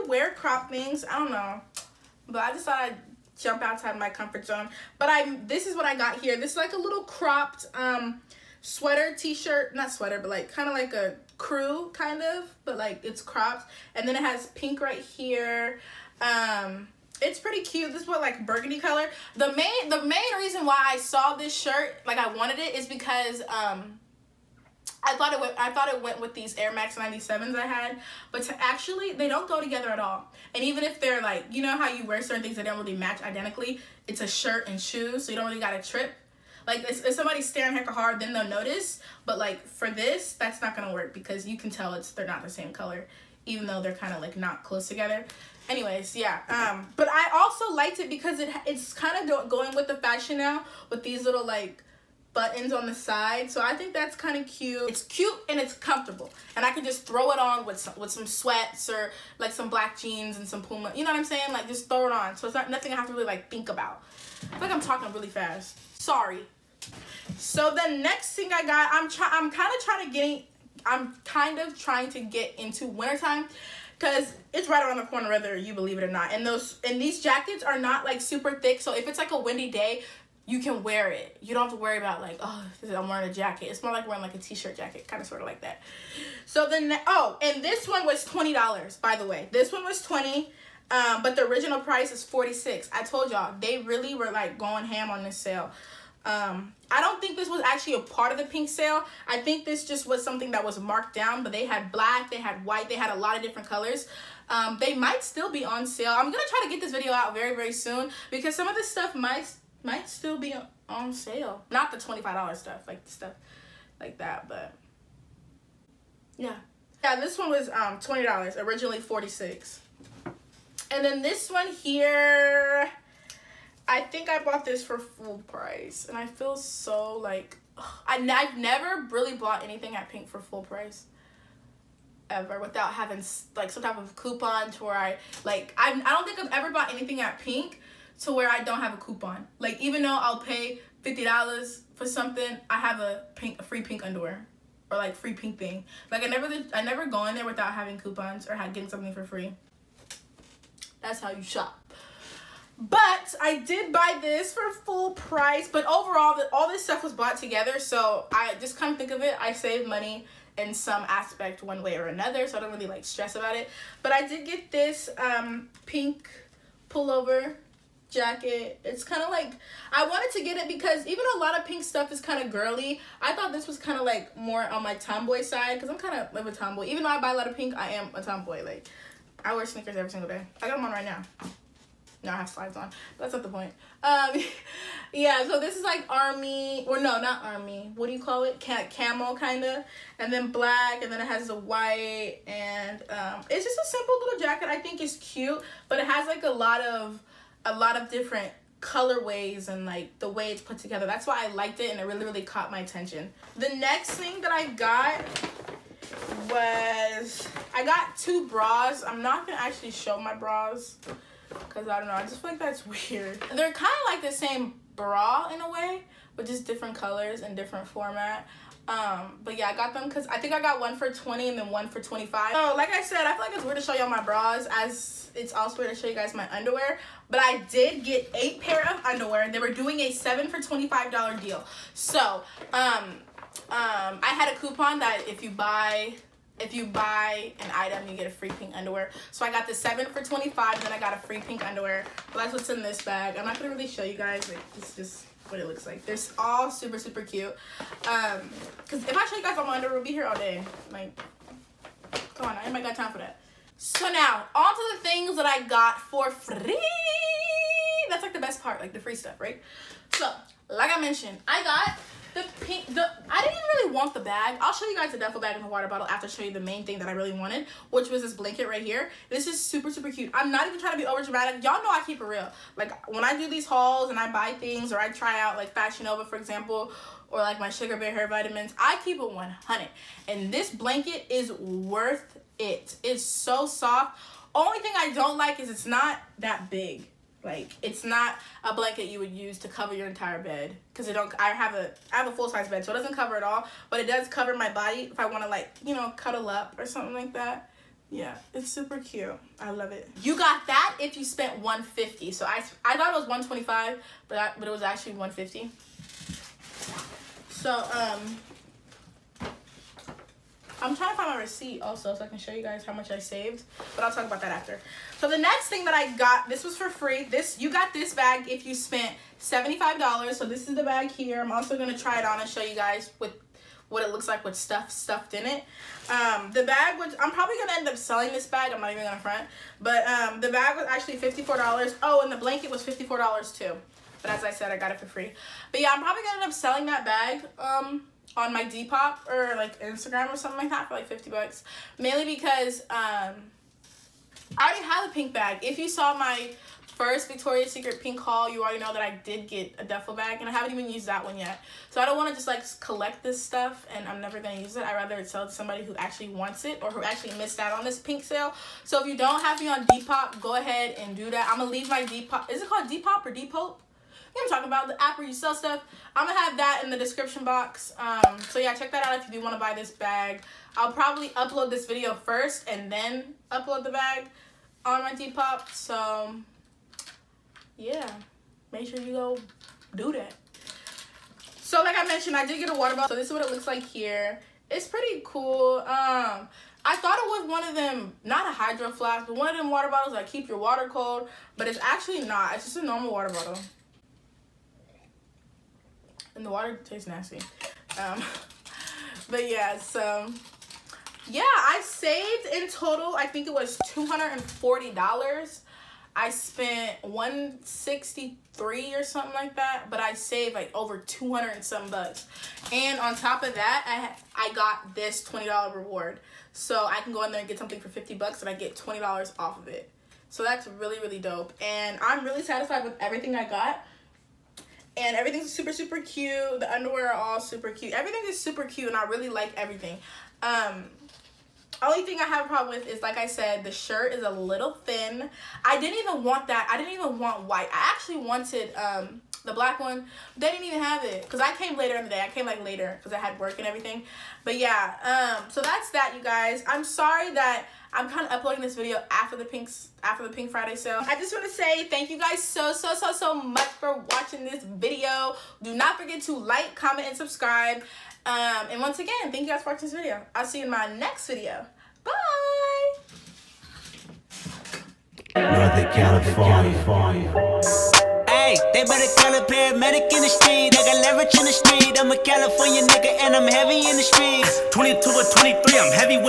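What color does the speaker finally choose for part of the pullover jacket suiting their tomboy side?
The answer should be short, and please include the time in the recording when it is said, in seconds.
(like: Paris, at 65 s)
Camel, at 188 s.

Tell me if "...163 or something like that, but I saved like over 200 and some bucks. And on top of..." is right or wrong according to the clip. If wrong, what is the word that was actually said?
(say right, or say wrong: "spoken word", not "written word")
right.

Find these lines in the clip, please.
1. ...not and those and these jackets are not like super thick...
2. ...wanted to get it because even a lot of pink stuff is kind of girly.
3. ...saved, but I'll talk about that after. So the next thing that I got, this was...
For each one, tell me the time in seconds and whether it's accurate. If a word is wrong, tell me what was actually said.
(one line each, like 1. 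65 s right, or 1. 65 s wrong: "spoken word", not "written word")
1. 76 s right
2. 170 s right
3. 313 s right.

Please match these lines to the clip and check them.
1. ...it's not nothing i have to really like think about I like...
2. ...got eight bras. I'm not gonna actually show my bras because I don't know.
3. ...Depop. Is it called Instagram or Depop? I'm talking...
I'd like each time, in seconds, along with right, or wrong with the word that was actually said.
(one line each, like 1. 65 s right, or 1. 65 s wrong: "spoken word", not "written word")
1. 62 s right
2. 207 s wrong: "two", not "eight"
3. 362 s wrong: "Depop", not "Instagram".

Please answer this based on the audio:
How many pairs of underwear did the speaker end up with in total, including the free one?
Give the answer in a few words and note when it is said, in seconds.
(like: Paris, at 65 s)
8, at 228 s.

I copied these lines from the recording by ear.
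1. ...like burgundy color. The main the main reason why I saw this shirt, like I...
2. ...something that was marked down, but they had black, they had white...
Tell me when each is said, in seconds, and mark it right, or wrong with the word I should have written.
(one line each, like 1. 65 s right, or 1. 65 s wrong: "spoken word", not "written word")
1. 18 s right
2. 100 s right.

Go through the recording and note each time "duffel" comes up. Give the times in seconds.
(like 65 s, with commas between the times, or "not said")
265 s, 349 s.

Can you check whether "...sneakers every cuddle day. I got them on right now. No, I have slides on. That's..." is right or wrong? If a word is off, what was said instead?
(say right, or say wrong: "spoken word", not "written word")
wrong: "single", not "cuddle".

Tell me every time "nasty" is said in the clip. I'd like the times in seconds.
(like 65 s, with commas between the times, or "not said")
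397 s.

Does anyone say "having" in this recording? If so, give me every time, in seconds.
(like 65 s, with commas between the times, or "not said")
132 s, 147 s.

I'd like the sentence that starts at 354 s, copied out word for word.
I'd rather sell it to somebody who actually wants it or who actually missed out on this pink sale.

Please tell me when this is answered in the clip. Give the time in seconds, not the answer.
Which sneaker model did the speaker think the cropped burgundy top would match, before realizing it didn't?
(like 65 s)
26 s.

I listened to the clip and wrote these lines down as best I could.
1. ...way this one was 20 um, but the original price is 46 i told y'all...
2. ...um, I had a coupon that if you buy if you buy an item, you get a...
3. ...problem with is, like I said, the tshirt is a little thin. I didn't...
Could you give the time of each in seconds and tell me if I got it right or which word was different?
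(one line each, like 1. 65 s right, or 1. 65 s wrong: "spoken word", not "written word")
1. 89 s right
2. 233 s right
3. 432 s wrong: "shirt", not "tshirt".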